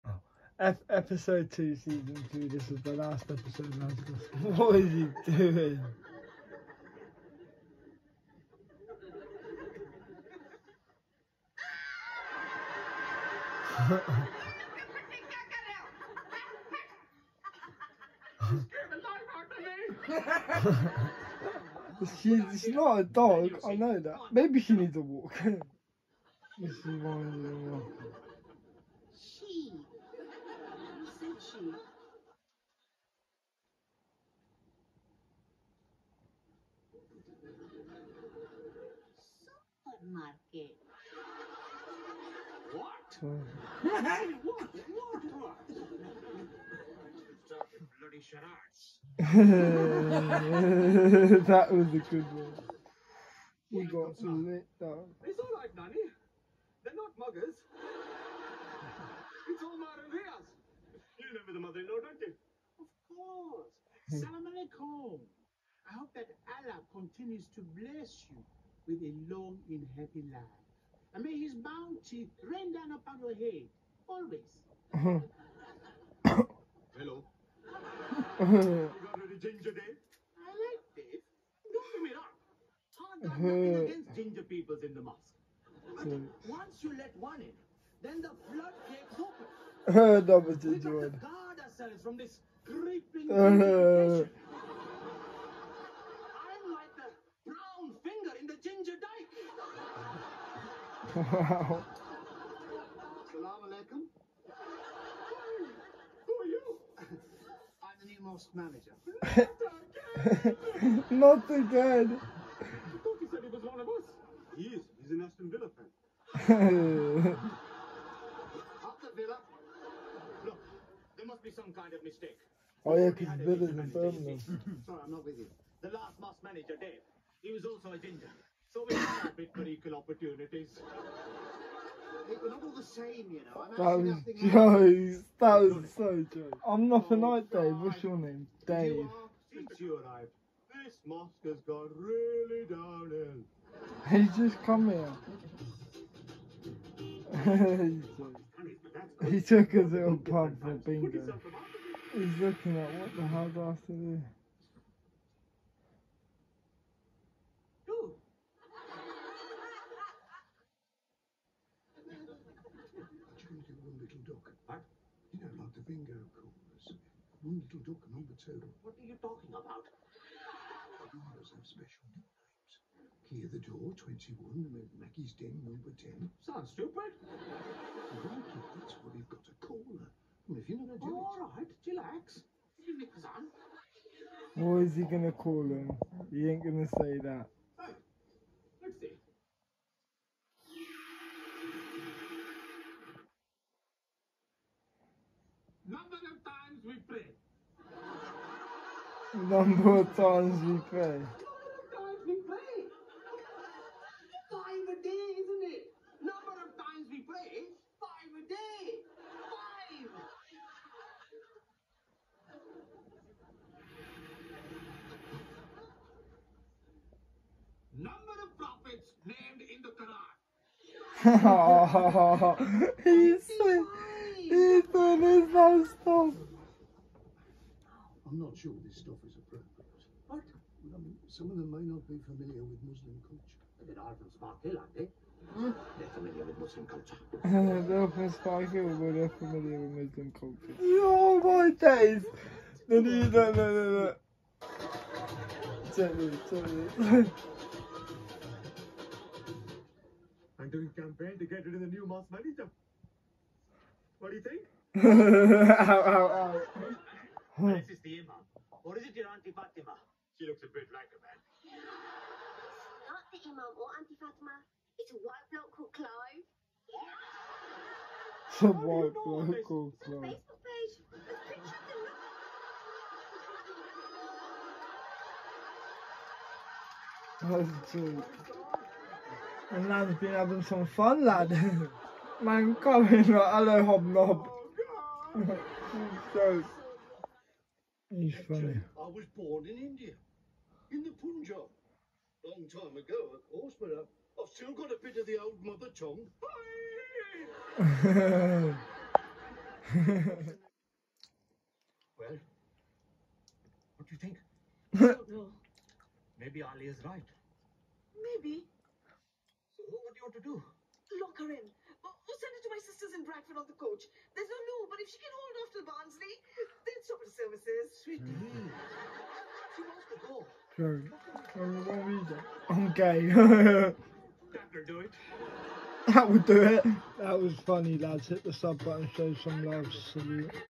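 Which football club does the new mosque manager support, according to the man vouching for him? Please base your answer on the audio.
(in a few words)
Aston Villa.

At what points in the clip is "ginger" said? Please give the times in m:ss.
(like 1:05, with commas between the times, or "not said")
1:19, 1:24, 1:38, 2:07.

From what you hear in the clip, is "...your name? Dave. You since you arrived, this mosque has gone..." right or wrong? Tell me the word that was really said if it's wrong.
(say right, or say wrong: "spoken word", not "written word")
right.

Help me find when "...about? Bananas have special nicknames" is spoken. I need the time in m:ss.
2:49.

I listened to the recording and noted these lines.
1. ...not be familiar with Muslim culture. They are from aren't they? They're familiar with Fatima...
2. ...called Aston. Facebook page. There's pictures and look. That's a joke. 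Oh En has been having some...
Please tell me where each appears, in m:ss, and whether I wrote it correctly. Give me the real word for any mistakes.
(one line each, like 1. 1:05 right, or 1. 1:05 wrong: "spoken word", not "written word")
1. 3:51 wrong: "Muslim", not "Fatima"
2. 4:29 wrong: "Clive", not "Aston".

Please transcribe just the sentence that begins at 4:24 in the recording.
It's a white bloke called Clive.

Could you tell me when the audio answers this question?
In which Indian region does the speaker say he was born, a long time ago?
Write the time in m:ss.
4:51.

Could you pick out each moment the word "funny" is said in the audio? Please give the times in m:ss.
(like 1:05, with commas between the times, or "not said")
4:48, 5:27.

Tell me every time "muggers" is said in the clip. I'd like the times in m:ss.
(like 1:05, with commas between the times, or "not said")
0:57.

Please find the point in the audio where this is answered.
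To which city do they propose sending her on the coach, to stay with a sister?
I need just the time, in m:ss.
5:13.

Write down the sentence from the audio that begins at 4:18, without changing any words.
Or is it your Auntie Fatima?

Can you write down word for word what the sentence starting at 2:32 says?
He's looking at what the hell's do I to do?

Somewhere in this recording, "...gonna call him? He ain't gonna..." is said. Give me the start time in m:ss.
3:05.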